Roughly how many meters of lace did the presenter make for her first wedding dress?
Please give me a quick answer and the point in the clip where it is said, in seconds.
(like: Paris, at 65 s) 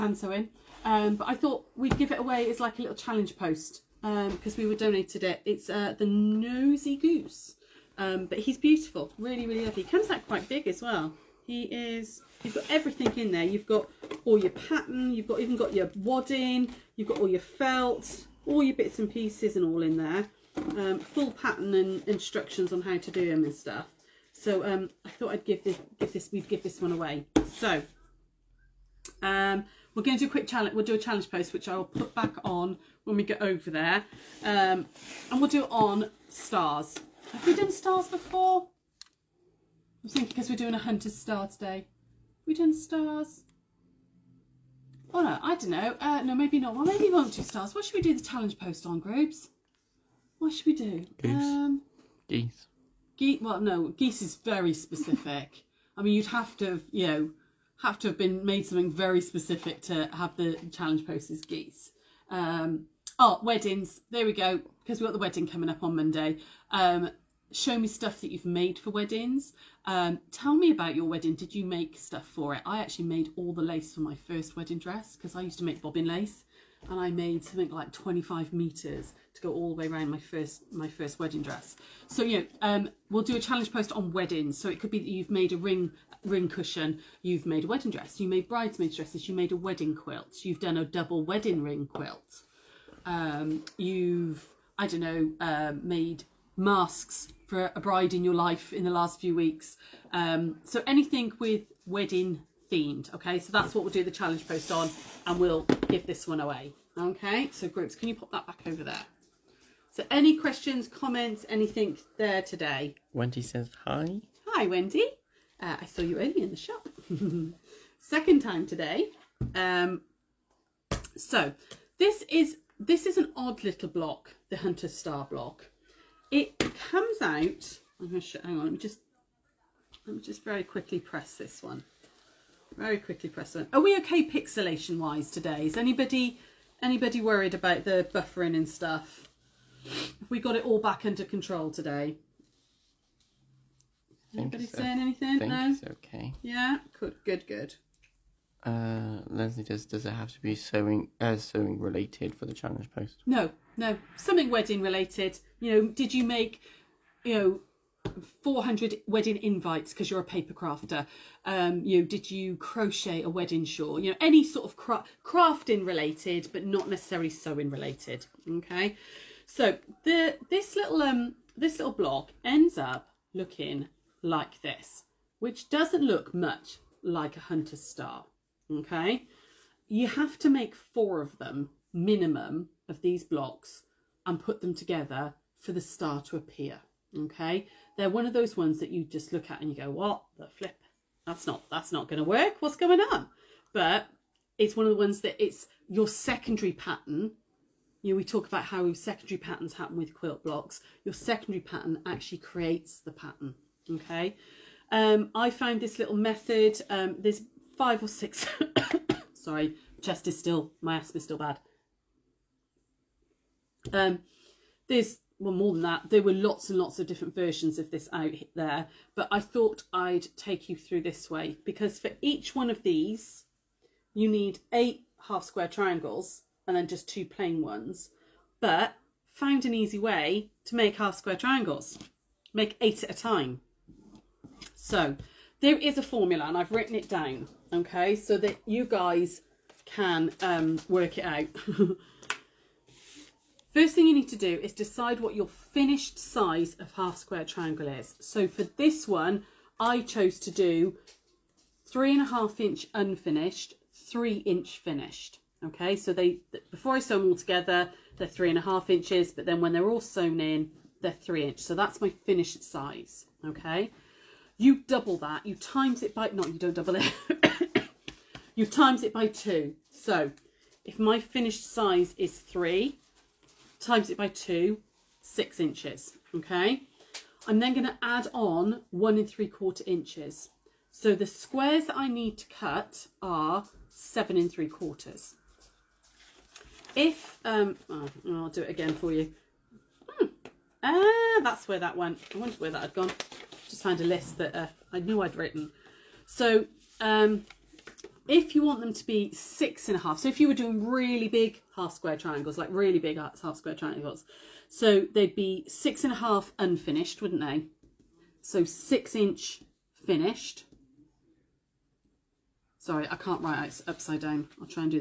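25, at 77 s.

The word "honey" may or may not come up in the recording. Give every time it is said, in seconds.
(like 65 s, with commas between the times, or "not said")
not said.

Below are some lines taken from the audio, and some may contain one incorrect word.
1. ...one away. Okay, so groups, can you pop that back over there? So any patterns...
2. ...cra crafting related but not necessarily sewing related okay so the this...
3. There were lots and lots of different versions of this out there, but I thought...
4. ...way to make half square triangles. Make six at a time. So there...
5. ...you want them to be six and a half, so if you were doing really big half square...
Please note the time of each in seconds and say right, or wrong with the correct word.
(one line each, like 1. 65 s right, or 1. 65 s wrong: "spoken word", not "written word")
1. 106 s wrong: "questions", not "patterns"
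2. 164 s right
3. 216 s right
4. 229 s wrong: "eight", not "six"
5. 298 s right.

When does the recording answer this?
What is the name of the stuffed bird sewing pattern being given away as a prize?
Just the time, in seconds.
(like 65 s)
5 s.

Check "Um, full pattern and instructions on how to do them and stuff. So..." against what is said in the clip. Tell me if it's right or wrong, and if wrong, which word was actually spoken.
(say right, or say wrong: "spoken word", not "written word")
right.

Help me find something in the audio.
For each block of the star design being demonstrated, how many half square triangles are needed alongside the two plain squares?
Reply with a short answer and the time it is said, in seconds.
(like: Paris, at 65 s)
8, at 224 s.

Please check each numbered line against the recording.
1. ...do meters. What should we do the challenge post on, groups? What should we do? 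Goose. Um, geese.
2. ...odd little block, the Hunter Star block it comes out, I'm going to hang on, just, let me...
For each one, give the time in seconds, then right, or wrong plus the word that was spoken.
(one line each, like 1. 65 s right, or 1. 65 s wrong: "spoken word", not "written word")
1. 47 s wrong: "stars", not "meters"
2. 123 s right.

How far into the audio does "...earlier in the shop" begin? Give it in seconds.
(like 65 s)
116 s.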